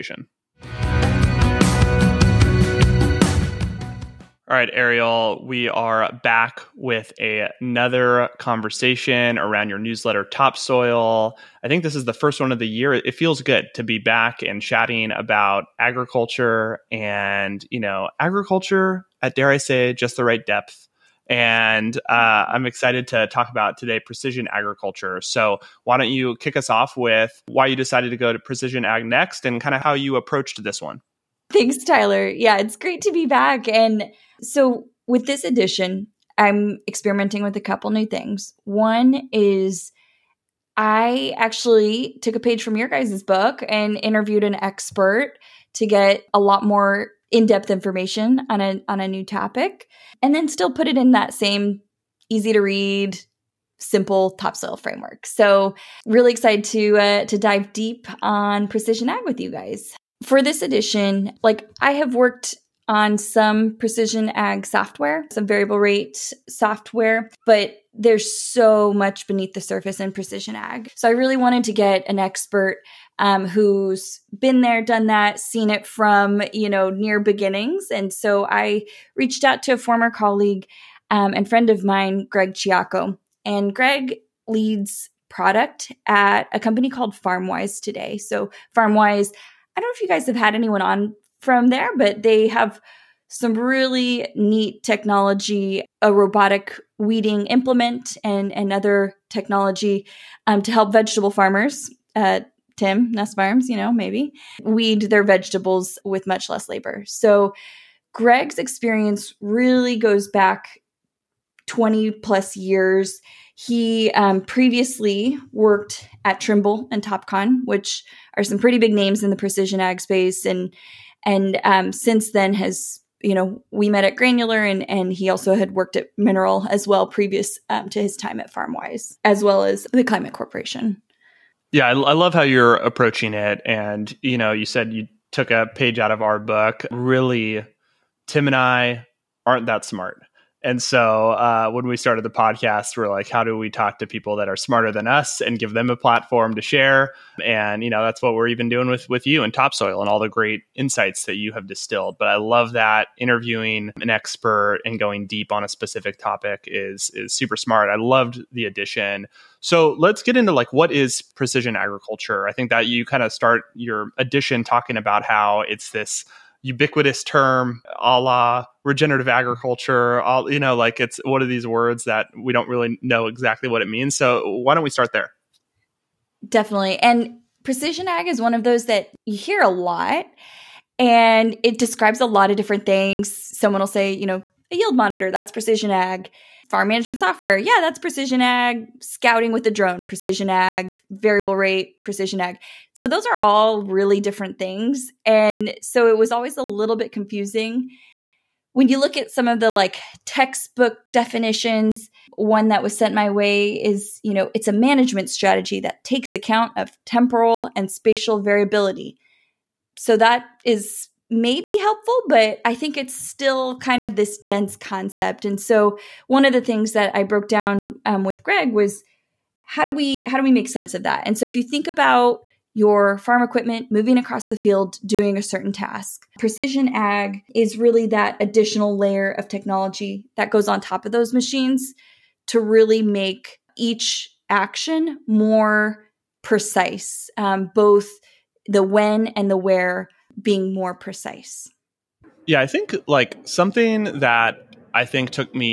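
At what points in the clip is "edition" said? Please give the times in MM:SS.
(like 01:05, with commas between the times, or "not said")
00:35, 01:00.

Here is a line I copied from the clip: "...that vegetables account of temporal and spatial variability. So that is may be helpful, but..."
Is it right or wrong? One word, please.
wrong.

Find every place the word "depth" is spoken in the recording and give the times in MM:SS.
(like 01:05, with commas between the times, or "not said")
00:20, 00:47.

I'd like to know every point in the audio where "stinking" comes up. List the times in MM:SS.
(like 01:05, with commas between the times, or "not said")
not said.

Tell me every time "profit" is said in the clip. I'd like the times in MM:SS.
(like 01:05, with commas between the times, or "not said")
not said.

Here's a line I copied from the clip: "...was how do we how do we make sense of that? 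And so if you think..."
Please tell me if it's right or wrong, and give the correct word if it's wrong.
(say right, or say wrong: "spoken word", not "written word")
right.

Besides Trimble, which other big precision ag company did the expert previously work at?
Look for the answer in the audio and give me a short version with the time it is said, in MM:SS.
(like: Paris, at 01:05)
Topcon, at 01:57.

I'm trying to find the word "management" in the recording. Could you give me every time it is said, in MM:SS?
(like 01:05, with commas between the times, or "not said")
03:06, 03:24.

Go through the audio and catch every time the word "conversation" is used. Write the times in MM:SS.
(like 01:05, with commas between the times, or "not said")
00:08.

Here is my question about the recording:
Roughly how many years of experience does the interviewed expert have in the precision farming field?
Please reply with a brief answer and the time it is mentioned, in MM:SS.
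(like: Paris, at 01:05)
20 plus years, at 01:51.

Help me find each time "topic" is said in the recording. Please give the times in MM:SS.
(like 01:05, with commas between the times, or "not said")
00:49, 02:36.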